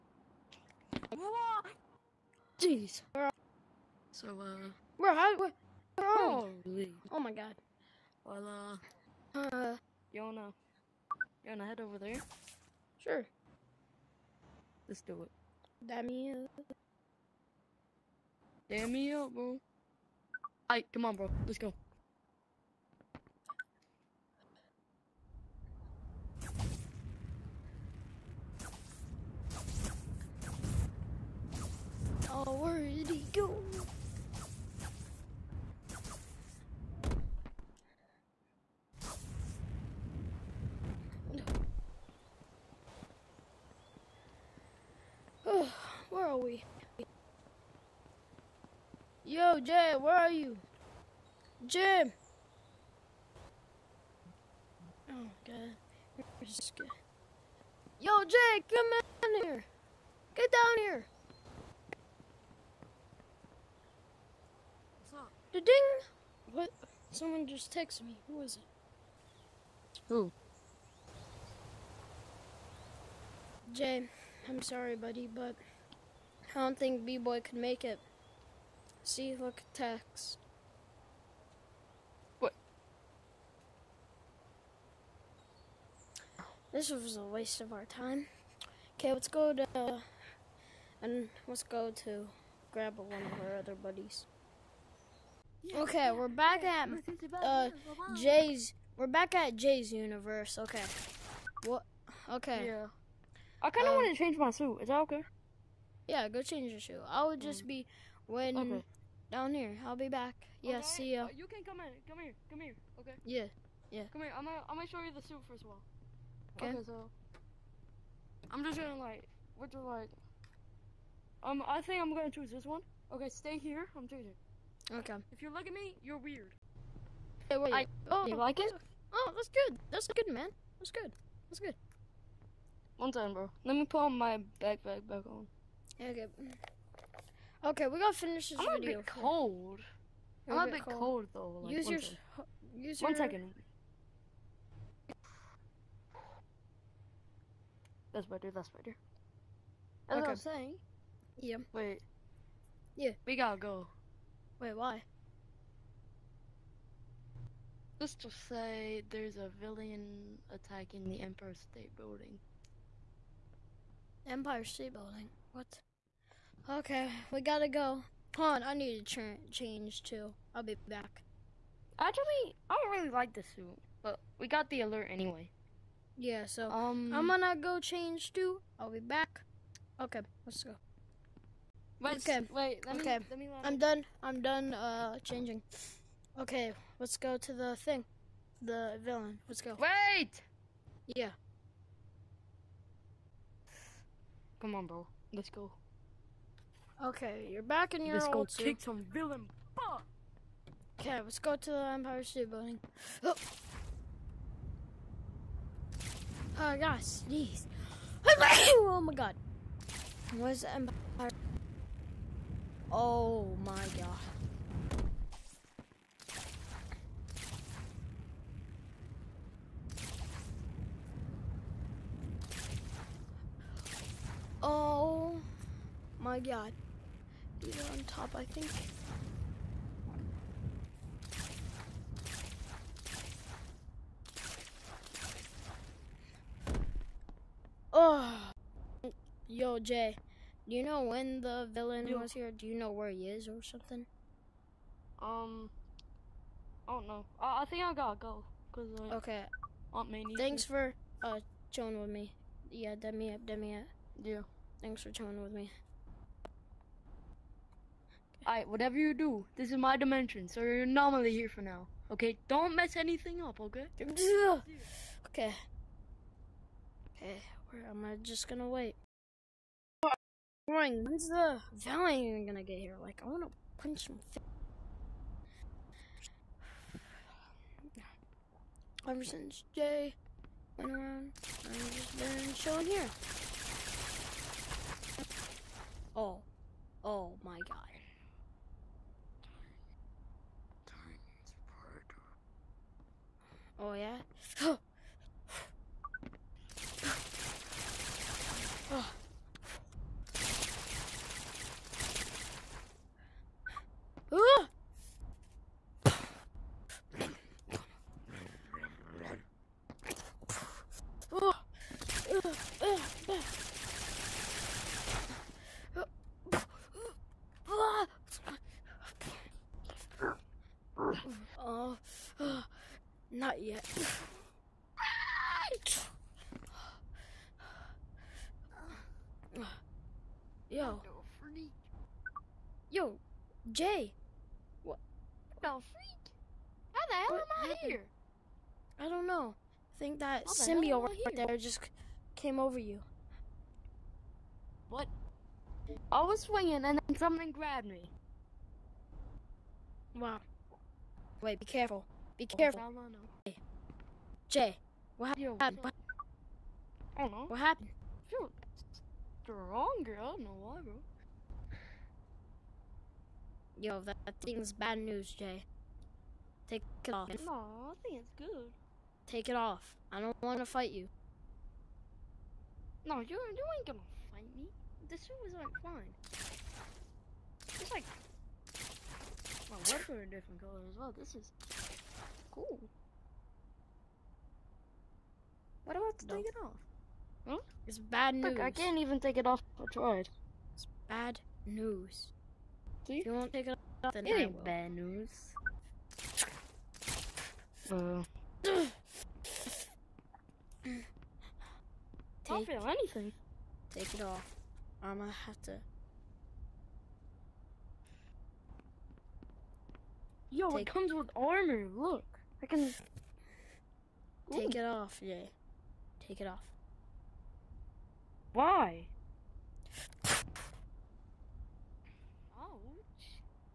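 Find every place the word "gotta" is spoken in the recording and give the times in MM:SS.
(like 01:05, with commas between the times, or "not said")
02:33, 02:47, 04:07.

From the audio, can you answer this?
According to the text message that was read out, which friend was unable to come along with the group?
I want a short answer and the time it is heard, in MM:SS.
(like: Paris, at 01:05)
B-Boy, at 01:17.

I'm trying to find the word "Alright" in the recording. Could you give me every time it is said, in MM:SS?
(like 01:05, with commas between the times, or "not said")
00:20, 04:18.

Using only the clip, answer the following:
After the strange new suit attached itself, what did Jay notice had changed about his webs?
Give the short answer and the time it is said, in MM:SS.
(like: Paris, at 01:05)
A different color, at 06:20.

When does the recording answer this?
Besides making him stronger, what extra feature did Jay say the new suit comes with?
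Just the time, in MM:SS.
06:51.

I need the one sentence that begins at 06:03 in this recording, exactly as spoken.
Yo, that, that thing's bad news, Jay.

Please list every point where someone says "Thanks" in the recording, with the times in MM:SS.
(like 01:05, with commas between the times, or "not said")
04:10, 04:14.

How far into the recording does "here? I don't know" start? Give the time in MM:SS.
05:37.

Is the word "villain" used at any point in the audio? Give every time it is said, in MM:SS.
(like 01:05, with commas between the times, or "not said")
02:39, 03:09, 03:19, 04:01.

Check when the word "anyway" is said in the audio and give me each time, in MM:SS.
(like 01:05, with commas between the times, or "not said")
02:55.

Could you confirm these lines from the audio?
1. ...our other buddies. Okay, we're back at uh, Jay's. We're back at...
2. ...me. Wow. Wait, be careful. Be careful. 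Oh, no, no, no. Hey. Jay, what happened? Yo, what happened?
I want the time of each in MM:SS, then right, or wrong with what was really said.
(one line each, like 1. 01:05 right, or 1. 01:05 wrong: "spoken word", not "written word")
1. 01:33 right
2. 05:47 right.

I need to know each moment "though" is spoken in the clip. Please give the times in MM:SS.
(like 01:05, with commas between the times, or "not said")
02:21.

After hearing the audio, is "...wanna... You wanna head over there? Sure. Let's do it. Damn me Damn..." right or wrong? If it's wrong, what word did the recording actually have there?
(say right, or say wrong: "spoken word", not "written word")
right.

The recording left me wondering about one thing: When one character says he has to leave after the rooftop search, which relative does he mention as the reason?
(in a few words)
Aunt May.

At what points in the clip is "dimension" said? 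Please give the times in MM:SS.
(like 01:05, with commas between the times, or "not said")
04:19.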